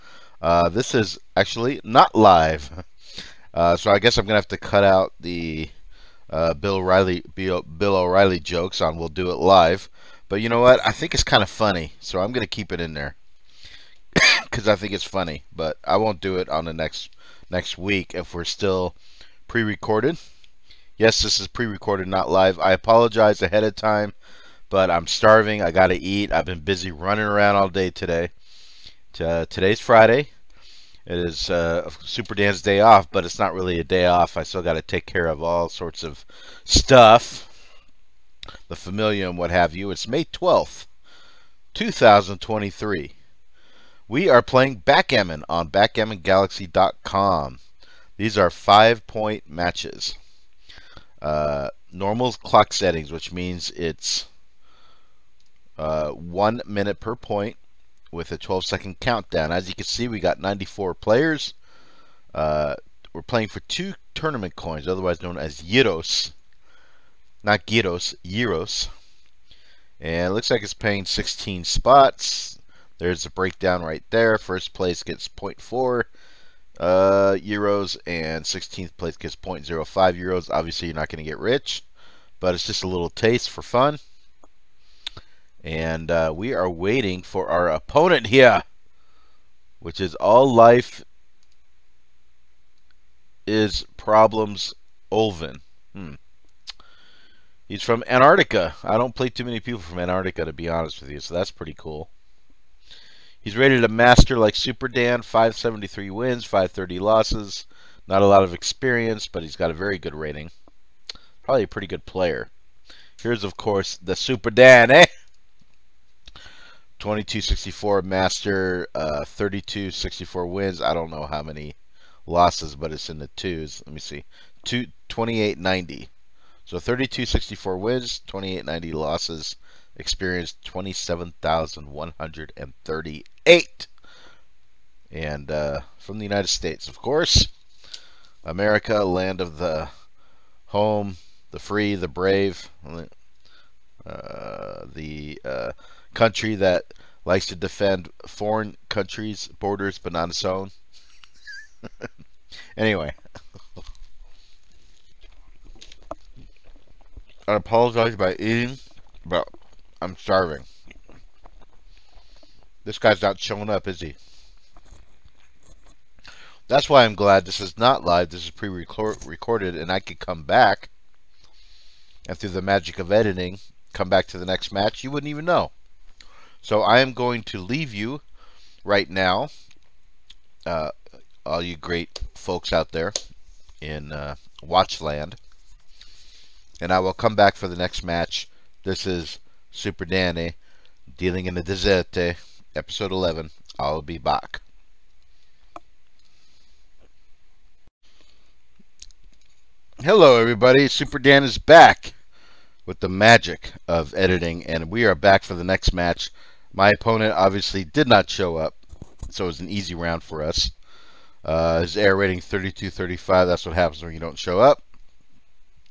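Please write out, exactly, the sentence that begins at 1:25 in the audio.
And uh, we are waiting for our opponent here, which is all life is problems Olvin.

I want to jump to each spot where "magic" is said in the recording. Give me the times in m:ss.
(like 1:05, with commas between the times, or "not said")
2:52, 3:23.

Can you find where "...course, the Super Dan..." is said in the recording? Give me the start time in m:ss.
1:53.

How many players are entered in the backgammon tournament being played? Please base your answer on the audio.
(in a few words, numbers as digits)
94.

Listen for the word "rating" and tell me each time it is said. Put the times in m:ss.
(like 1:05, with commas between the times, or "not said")
1:50, 3:32.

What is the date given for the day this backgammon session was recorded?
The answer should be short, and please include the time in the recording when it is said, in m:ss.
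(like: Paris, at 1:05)
May 12th, 2023, at 0:40.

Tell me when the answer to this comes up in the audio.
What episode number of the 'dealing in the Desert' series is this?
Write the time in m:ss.
3:13.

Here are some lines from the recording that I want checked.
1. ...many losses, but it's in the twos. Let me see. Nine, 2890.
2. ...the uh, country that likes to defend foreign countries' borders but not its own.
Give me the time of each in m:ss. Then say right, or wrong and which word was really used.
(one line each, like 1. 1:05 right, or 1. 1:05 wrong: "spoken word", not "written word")
1. 2:01 wrong: "Two", not "Nine"
2. 2:24 right.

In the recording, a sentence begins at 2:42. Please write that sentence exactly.
This guy's not showing up, is he?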